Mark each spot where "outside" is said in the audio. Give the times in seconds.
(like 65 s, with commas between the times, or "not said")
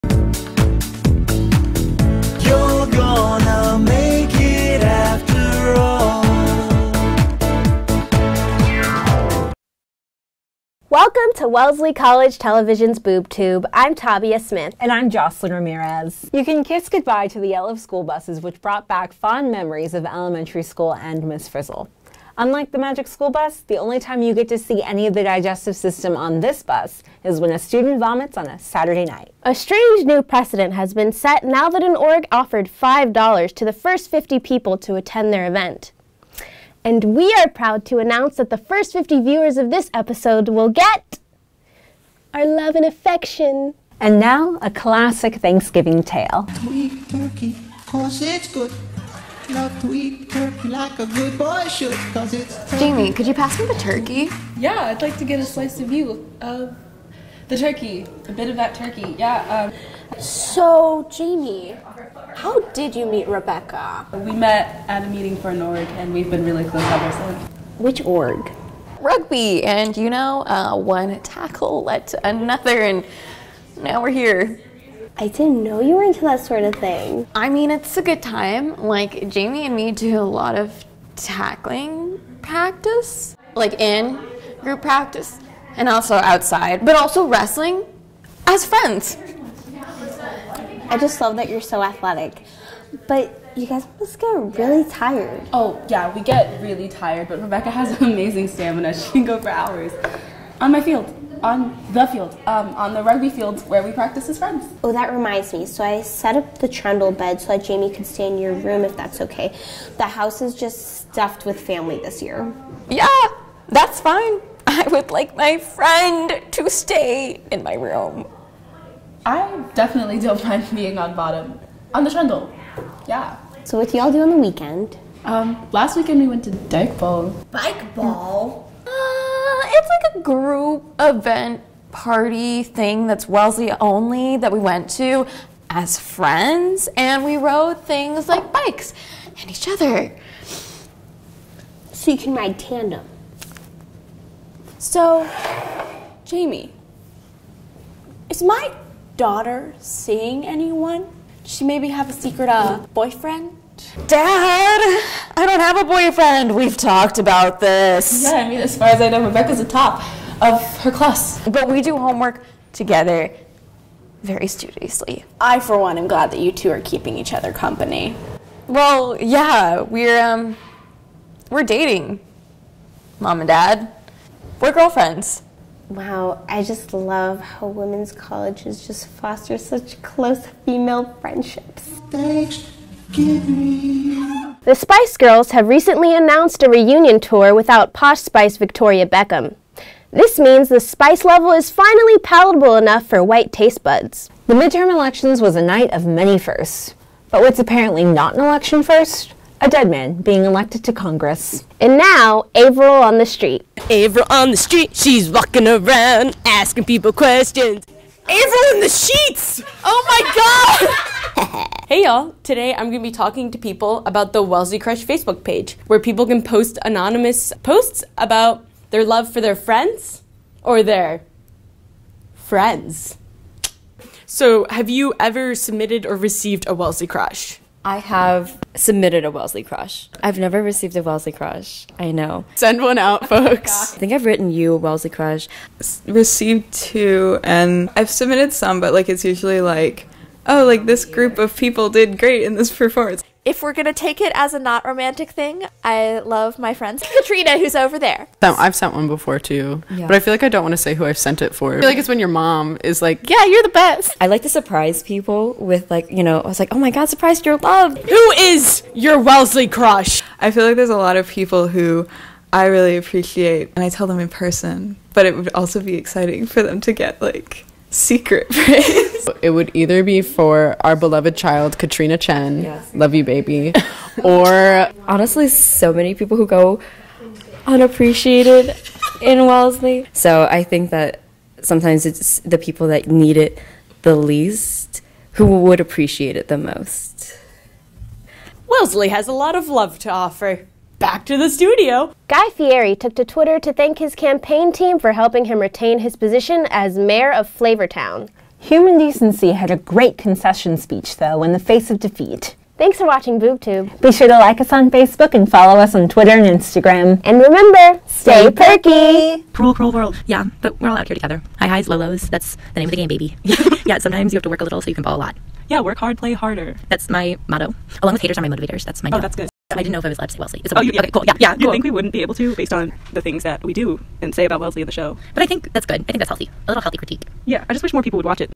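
86 s.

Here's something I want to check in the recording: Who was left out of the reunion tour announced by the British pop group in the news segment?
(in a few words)
Victoria Beckham.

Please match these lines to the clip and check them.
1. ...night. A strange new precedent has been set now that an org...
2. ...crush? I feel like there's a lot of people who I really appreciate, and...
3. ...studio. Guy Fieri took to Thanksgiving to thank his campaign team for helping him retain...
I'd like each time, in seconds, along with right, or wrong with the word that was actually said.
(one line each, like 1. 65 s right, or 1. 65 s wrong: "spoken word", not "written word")
1. 29 s right
2. 259 s right
3. 291 s wrong: "Twitter", not "Thanksgiving".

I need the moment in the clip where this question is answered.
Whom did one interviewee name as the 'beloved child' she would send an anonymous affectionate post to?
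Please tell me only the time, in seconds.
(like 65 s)
271 s.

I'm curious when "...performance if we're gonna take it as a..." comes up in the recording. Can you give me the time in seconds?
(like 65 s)
242 s.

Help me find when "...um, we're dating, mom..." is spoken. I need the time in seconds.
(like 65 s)
170 s.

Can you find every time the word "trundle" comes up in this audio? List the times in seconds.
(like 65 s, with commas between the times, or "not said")
106 s, 122 s.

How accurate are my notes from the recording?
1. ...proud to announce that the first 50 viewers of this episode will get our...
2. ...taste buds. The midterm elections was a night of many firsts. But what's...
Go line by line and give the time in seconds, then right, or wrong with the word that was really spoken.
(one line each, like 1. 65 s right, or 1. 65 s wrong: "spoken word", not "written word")
1. 37 s right
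2. 193 s right.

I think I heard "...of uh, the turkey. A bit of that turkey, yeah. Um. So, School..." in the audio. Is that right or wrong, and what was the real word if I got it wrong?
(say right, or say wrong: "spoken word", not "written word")
wrong: "Jamie", not "School".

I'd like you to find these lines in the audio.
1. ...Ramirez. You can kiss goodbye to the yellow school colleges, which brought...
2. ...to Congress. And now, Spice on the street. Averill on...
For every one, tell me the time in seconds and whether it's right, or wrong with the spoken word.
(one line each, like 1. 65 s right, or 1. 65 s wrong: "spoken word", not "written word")
1. 15 s wrong: "buses", not "colleges"
2. 200 s wrong: "Averill", not "Spice".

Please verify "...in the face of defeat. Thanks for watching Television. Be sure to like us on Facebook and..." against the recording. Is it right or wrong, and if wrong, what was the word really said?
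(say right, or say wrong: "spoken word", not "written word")
wrong: "BoobTube", not "Television".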